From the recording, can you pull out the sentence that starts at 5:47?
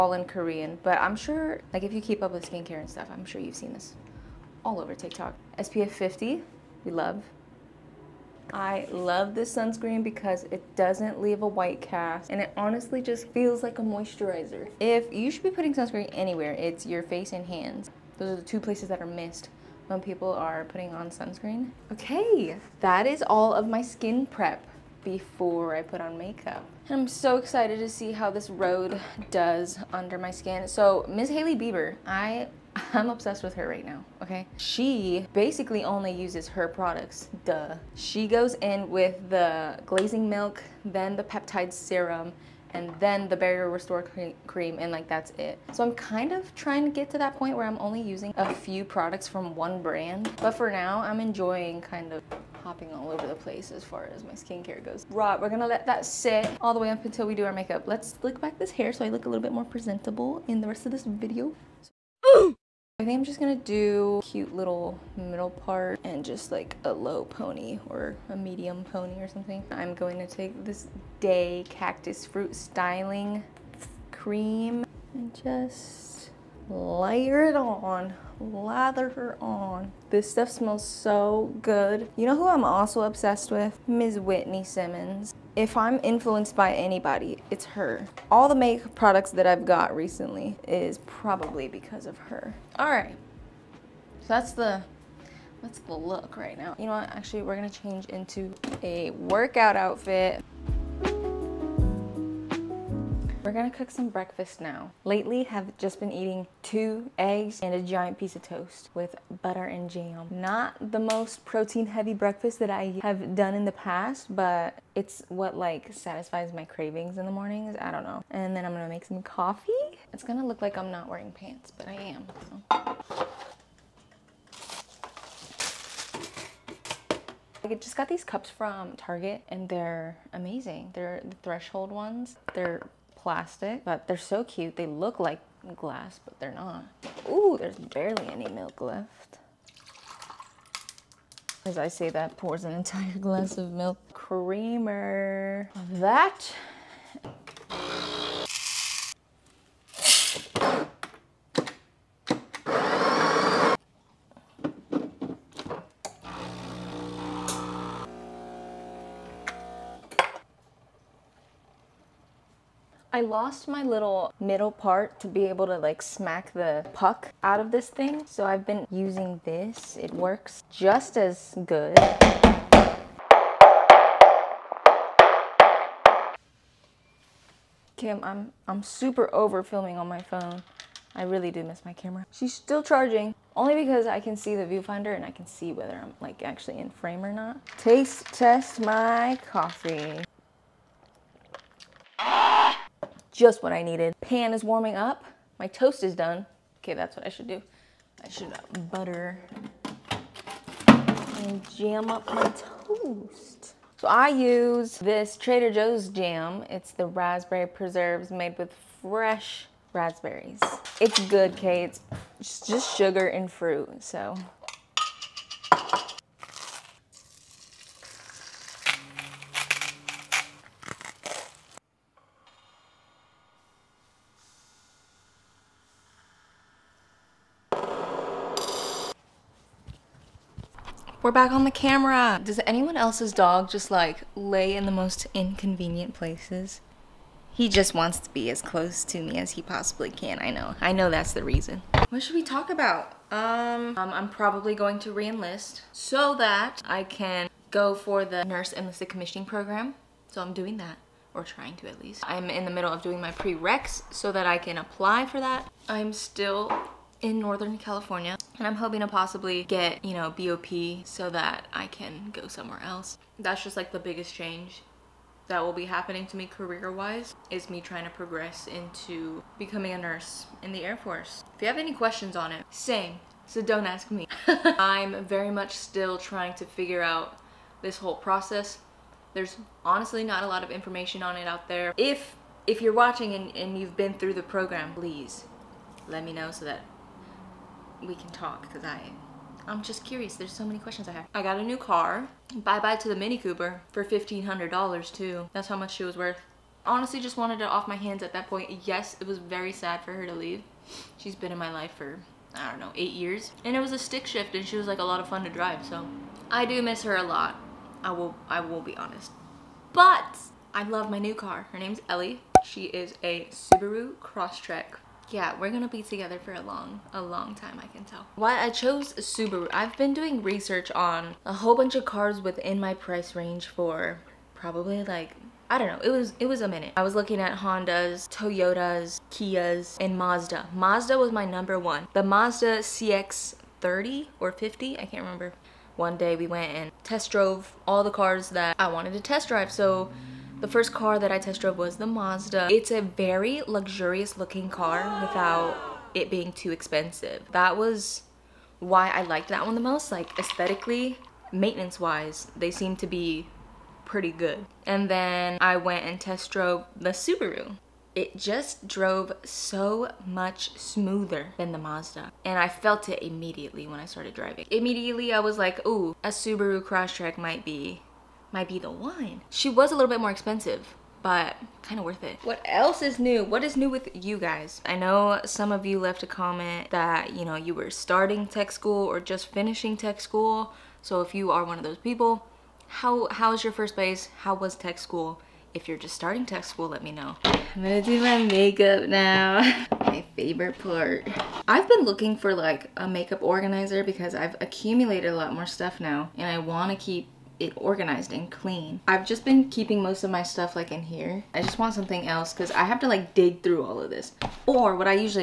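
That was why I liked that one the most.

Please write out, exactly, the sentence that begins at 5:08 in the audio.
I will, I will be honest.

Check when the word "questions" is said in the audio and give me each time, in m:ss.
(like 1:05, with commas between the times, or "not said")
4:31, 4:50.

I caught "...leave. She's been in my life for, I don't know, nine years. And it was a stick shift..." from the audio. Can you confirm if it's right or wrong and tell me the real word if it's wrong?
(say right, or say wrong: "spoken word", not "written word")
wrong: "eight", not "nine".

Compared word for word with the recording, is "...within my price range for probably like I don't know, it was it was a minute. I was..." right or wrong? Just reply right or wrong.
right.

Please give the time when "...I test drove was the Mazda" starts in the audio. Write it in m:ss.
5:41.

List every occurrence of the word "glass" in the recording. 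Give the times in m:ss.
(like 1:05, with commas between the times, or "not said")
2:15, 2:23.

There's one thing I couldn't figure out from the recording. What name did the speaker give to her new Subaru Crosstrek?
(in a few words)
Ellie.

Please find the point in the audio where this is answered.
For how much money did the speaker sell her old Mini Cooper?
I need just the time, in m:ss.
4:54.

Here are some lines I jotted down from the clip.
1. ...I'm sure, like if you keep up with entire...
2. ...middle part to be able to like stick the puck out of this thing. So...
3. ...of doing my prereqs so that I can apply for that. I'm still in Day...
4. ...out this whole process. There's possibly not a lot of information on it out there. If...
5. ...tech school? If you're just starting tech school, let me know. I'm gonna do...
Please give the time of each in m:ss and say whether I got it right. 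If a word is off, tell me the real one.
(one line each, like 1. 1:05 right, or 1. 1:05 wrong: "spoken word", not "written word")
1. 0:01 wrong: "skincare", not "entire"
2. 2:44 wrong: "smack", not "stick"
3. 4:12 wrong: "Northern", not "Day"
4. 4:37 wrong: "honestly", not "possibly"
5. 6:24 right.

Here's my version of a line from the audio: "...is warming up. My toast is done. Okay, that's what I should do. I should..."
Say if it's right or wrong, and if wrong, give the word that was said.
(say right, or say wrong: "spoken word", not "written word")
right.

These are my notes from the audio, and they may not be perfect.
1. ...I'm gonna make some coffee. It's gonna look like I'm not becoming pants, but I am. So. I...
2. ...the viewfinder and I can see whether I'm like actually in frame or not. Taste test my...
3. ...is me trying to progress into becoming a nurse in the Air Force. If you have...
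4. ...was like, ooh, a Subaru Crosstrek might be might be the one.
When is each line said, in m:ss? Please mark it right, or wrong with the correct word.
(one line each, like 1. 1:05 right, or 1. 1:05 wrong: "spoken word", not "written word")
1. 1:58 wrong: "wearing", not "becoming"
2. 3:04 right
3. 4:27 right
4. 6:05 right.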